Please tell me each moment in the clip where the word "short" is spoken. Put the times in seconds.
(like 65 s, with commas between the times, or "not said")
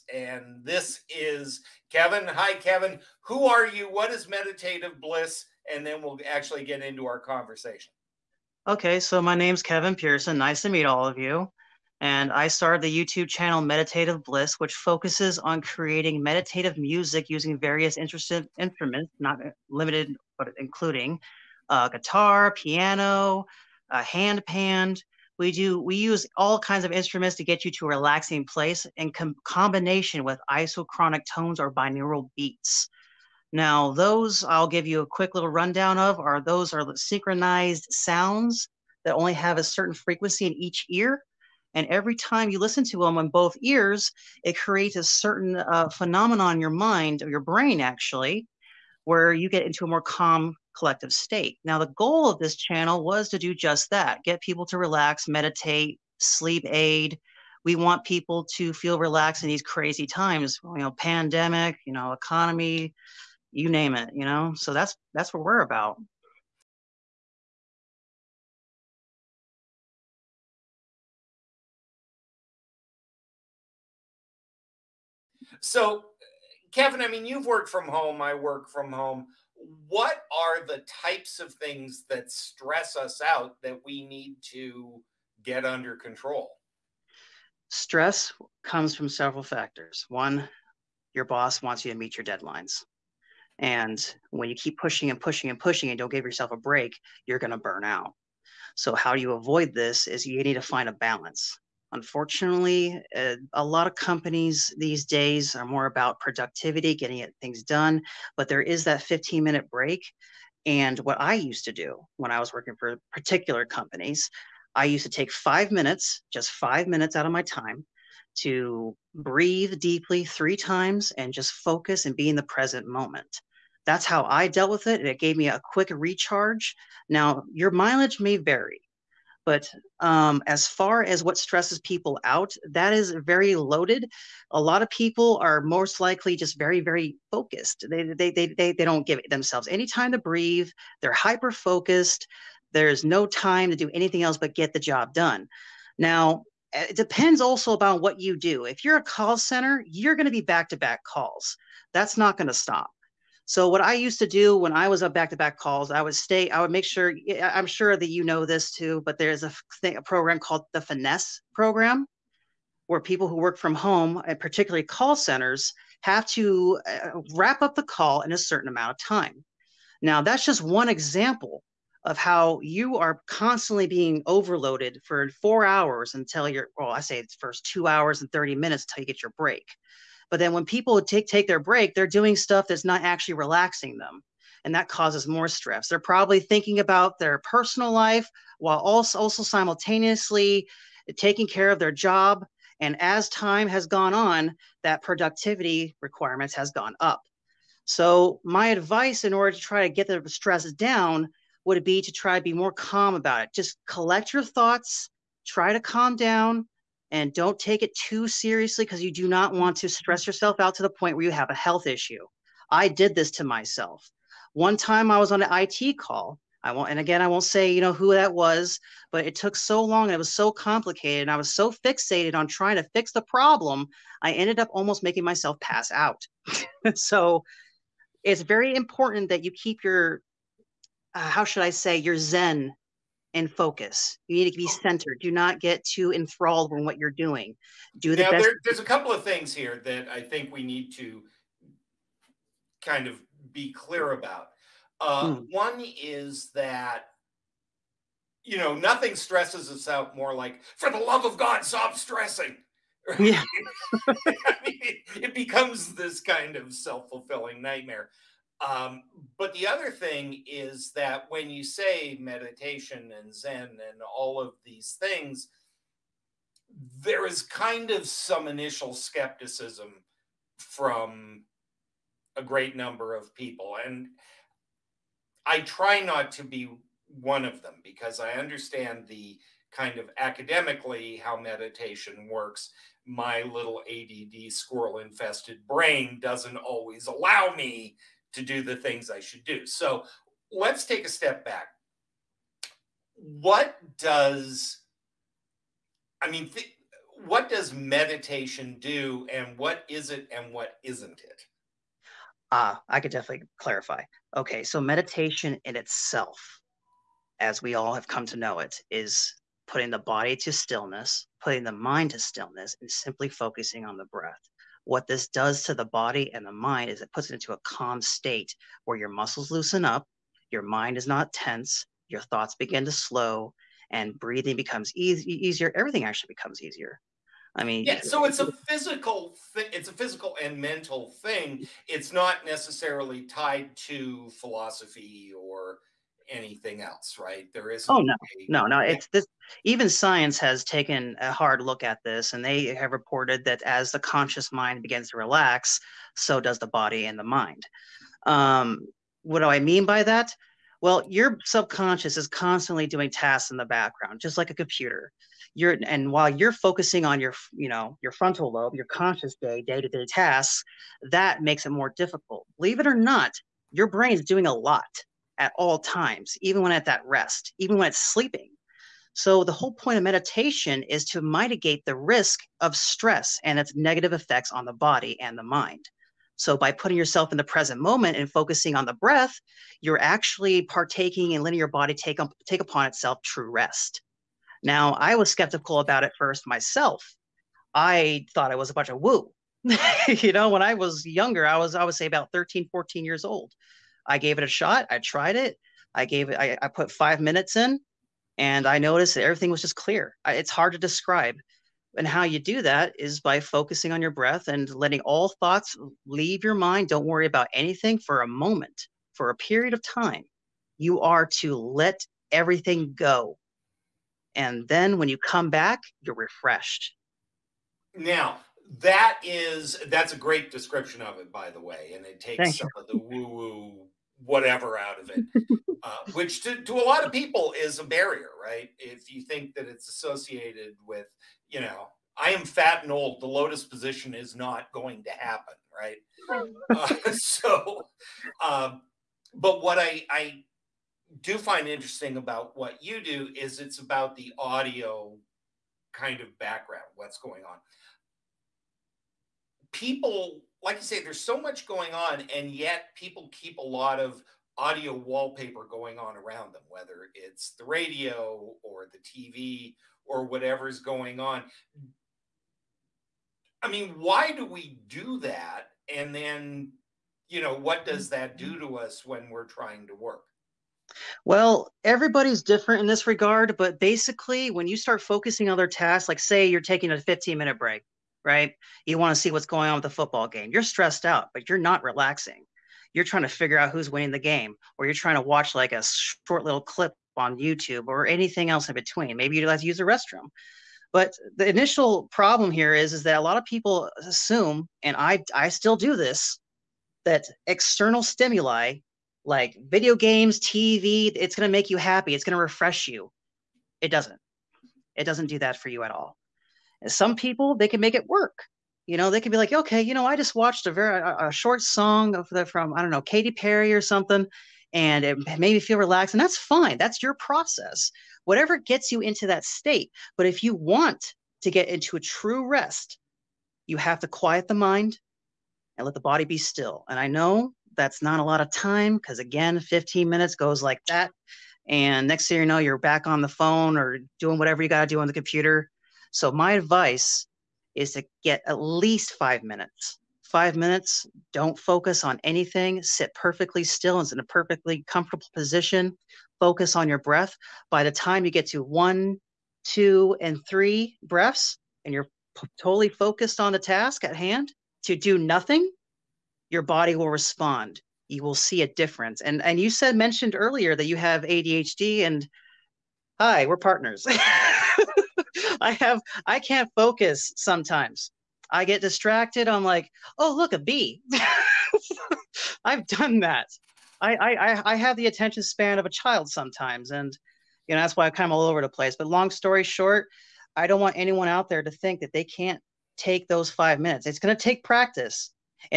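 486 s, 511 s, 579 s.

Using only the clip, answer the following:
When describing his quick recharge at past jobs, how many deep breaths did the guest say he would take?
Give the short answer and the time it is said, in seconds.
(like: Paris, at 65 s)
3, at 120 s.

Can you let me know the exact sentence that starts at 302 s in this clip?
Ah, uh, I could definitely clarify.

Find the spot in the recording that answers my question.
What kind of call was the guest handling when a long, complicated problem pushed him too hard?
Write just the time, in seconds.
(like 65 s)
215 s.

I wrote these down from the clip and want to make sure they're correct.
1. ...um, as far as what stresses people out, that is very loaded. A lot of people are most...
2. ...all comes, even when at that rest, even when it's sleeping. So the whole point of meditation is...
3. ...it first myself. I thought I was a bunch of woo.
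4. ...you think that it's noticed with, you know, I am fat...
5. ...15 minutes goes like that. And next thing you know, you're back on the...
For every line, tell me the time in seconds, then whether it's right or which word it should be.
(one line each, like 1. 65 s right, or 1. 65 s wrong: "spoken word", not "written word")
1. 129 s right
2. 365 s wrong: "times", not "comes"
3. 386 s right
4. 429 s wrong: "associated", not "noticed"
5. 529 s right.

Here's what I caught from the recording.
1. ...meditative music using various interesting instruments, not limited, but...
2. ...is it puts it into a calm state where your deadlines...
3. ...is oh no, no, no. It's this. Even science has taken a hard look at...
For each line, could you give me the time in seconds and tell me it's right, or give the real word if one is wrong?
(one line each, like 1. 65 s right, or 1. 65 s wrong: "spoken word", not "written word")
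1. 16 s right
2. 316 s wrong: "muscles", not "deadlines"
3. 337 s right.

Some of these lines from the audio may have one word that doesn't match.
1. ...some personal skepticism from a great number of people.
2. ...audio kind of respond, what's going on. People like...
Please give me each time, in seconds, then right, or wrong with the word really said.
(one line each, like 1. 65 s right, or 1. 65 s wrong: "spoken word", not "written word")
1. 268 s wrong: "initial", not "personal"
2. 444 s wrong: "background", not "respond".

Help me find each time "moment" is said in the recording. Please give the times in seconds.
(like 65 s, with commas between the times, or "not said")
122 s, 377 s, 408 s.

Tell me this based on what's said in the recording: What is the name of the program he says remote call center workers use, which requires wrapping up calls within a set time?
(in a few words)
Finesse.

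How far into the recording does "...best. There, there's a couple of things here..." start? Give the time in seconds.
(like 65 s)
238 s.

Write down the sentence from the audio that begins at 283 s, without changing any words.
My little ADD squirrel infested brain doesn't always allow me to do the things I should do.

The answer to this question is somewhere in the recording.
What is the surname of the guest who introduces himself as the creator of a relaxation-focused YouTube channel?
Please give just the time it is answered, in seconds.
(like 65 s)
9 s.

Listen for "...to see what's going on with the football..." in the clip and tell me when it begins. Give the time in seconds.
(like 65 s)
479 s.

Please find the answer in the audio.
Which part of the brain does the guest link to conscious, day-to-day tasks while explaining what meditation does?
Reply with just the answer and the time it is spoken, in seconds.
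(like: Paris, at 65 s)
Frontal lobe, at 358 s.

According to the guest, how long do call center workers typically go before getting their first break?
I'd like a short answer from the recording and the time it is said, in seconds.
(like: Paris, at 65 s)
2 hours and 30 minutes, at 177 s.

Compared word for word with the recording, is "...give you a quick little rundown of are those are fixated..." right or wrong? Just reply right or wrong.
wrong.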